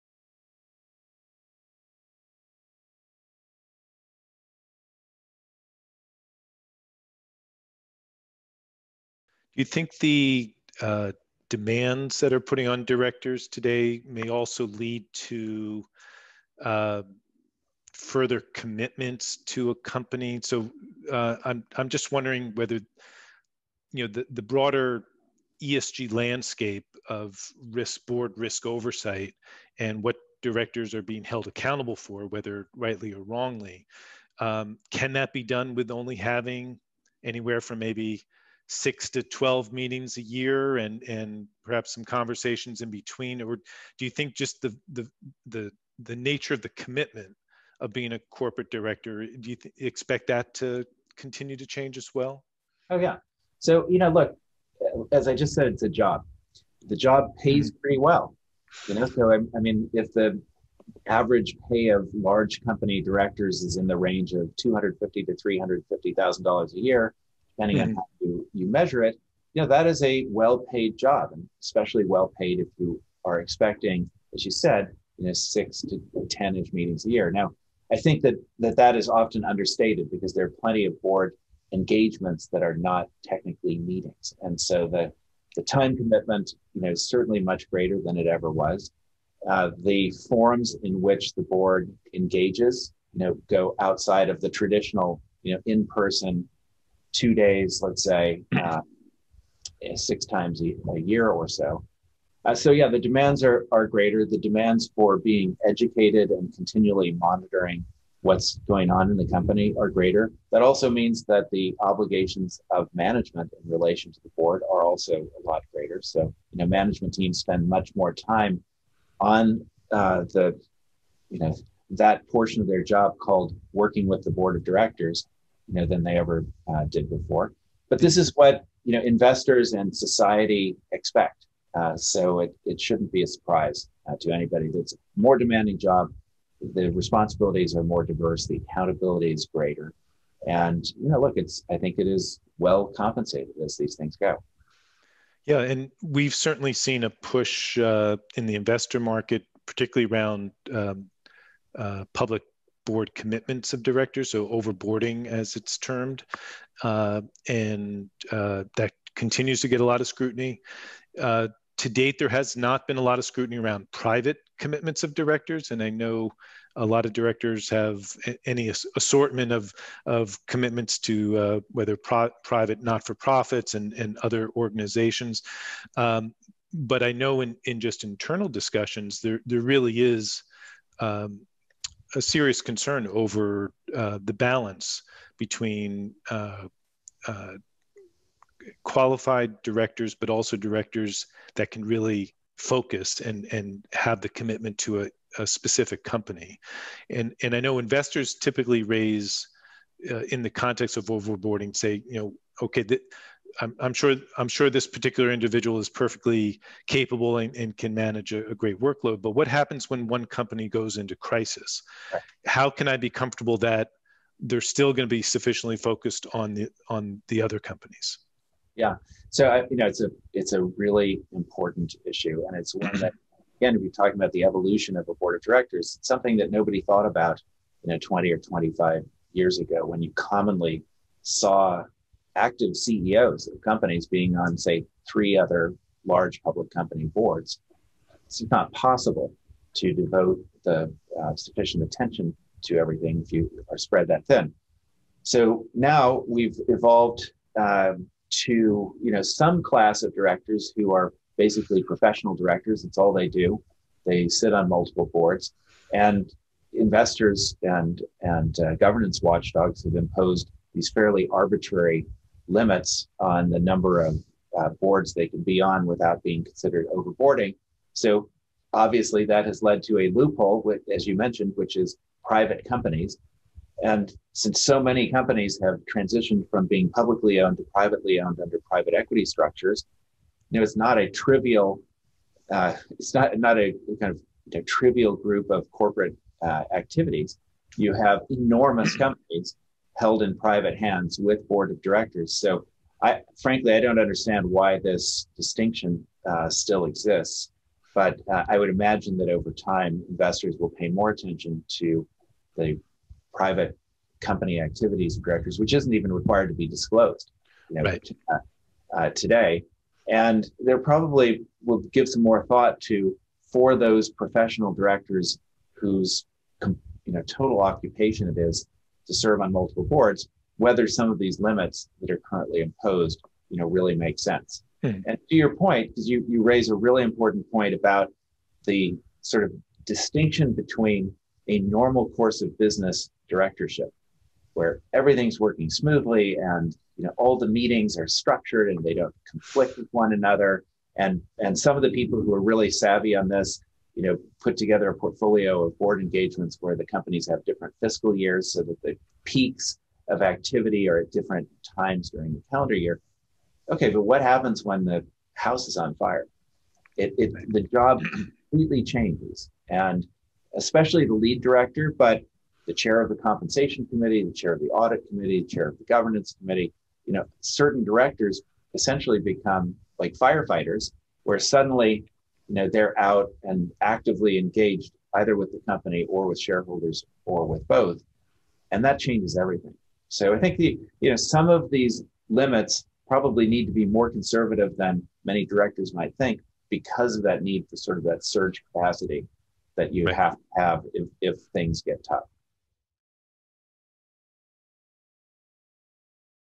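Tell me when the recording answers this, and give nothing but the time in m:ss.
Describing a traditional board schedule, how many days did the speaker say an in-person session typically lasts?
1:37.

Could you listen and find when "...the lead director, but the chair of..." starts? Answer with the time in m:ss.
6:01.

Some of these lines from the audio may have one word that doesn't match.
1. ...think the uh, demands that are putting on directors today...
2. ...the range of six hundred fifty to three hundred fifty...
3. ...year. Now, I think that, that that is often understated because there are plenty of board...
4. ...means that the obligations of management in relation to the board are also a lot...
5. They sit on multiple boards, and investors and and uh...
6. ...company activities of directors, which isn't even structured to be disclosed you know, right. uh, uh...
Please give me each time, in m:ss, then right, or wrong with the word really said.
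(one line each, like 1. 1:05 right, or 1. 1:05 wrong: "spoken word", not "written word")
1. 0:09 right
2. 1:03 wrong: "two", not "six"
3. 1:17 right
4. 1:50 right
5. 4:14 right
6. 5:04 wrong: "required", not "structured".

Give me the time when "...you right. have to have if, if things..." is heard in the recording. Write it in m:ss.
6:29.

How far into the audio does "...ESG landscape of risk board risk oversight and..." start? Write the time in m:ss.
0:25.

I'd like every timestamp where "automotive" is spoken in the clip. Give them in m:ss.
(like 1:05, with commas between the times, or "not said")
not said.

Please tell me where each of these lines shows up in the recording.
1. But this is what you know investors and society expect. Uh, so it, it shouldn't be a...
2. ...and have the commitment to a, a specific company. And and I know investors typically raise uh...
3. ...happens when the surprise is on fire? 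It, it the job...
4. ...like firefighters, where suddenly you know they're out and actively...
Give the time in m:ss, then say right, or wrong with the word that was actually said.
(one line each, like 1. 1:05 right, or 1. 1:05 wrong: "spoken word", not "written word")
1. 2:07 right
2. 3:13 right
3. 5:54 wrong: "house", not "surprise"
4. 6:09 right.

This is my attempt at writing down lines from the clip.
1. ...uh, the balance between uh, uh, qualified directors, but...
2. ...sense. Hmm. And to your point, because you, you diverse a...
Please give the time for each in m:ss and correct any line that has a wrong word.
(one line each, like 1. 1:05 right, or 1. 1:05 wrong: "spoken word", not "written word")
1. 3:03 right
2. 5:24 wrong: "raise", not "diverse".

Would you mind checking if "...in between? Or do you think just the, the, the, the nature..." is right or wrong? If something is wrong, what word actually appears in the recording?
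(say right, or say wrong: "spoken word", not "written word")
right.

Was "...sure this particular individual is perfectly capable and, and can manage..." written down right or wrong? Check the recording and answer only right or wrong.
right.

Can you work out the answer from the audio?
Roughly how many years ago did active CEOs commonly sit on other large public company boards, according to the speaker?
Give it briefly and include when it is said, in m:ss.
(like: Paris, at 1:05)
20 or 25 years, at 3:48.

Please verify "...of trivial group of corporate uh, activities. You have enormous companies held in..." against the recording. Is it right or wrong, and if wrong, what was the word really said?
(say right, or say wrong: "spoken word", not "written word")
right.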